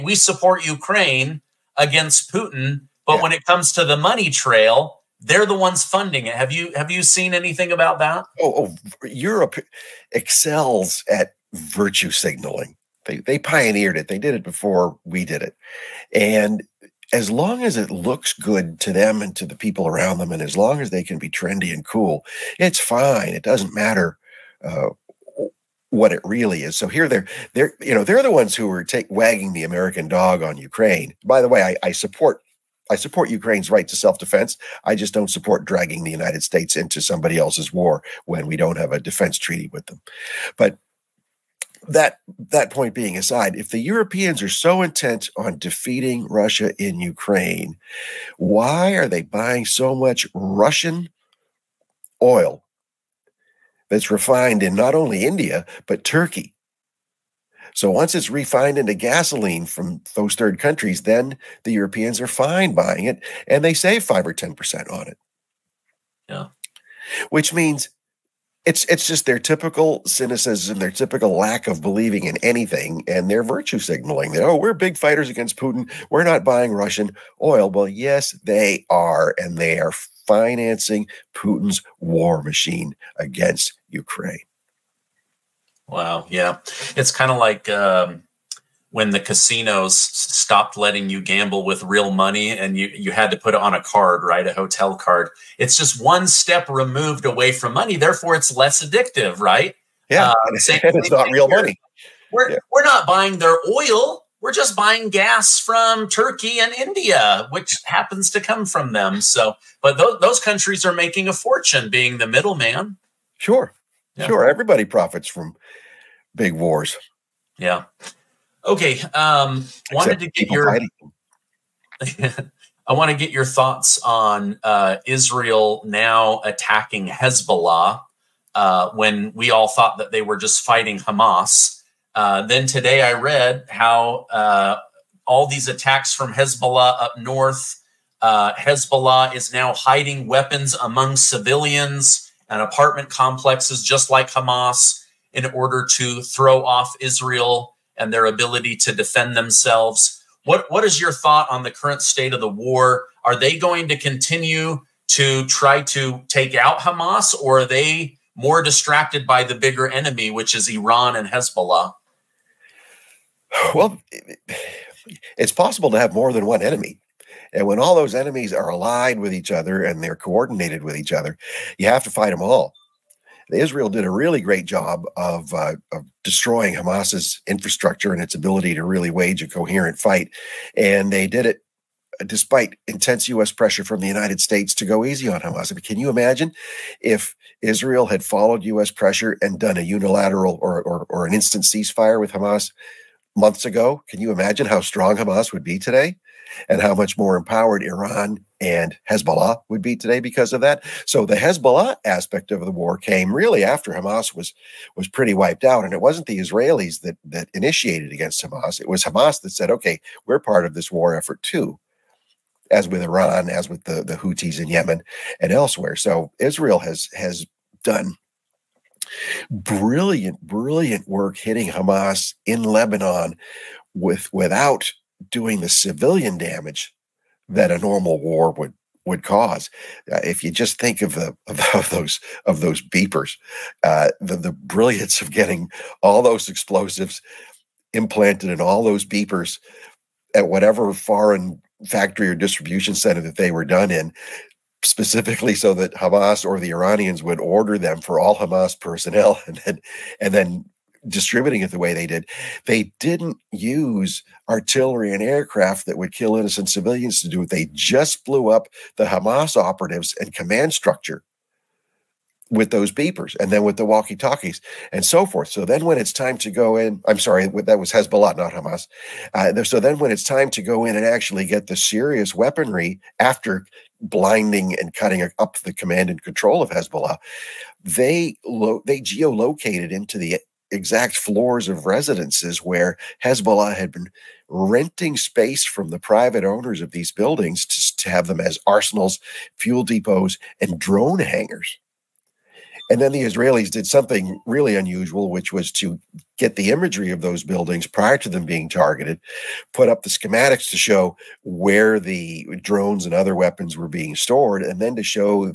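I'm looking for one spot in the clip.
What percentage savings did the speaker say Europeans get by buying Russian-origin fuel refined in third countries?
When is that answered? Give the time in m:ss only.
1:04.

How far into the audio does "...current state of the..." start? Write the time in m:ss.
2:31.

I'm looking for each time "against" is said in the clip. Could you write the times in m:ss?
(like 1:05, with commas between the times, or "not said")
0:01, 1:15, 1:23, 3:28.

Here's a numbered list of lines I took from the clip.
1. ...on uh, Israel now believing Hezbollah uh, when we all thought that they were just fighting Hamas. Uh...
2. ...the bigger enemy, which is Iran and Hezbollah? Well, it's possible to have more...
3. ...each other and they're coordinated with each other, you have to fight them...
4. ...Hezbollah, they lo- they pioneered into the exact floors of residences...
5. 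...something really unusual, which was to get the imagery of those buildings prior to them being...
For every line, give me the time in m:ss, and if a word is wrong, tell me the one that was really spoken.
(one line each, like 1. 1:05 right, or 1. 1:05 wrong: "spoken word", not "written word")
1. 2:04 wrong: "attacking", not "believing"
2. 2:39 right
3. 2:49 right
4. 4:36 wrong: "geolocated", not "pioneered"
5. 4:53 right.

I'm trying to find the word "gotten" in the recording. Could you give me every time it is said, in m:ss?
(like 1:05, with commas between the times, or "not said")
not said.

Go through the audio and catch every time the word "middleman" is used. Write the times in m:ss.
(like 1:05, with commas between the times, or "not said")
1:52.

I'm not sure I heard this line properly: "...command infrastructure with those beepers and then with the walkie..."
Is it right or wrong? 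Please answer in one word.
wrong.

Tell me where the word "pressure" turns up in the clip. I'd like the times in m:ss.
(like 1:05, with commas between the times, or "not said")
3:03, 3:08.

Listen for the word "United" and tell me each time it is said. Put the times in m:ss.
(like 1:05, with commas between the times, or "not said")
0:36, 3:04.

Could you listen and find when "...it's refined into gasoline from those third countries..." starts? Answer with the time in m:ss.
0:58.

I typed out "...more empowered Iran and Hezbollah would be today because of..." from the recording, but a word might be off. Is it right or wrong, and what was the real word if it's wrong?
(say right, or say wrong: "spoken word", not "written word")
right.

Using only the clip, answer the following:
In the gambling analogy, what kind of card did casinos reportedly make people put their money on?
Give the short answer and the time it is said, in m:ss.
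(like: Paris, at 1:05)
A hotel card, at 1:34.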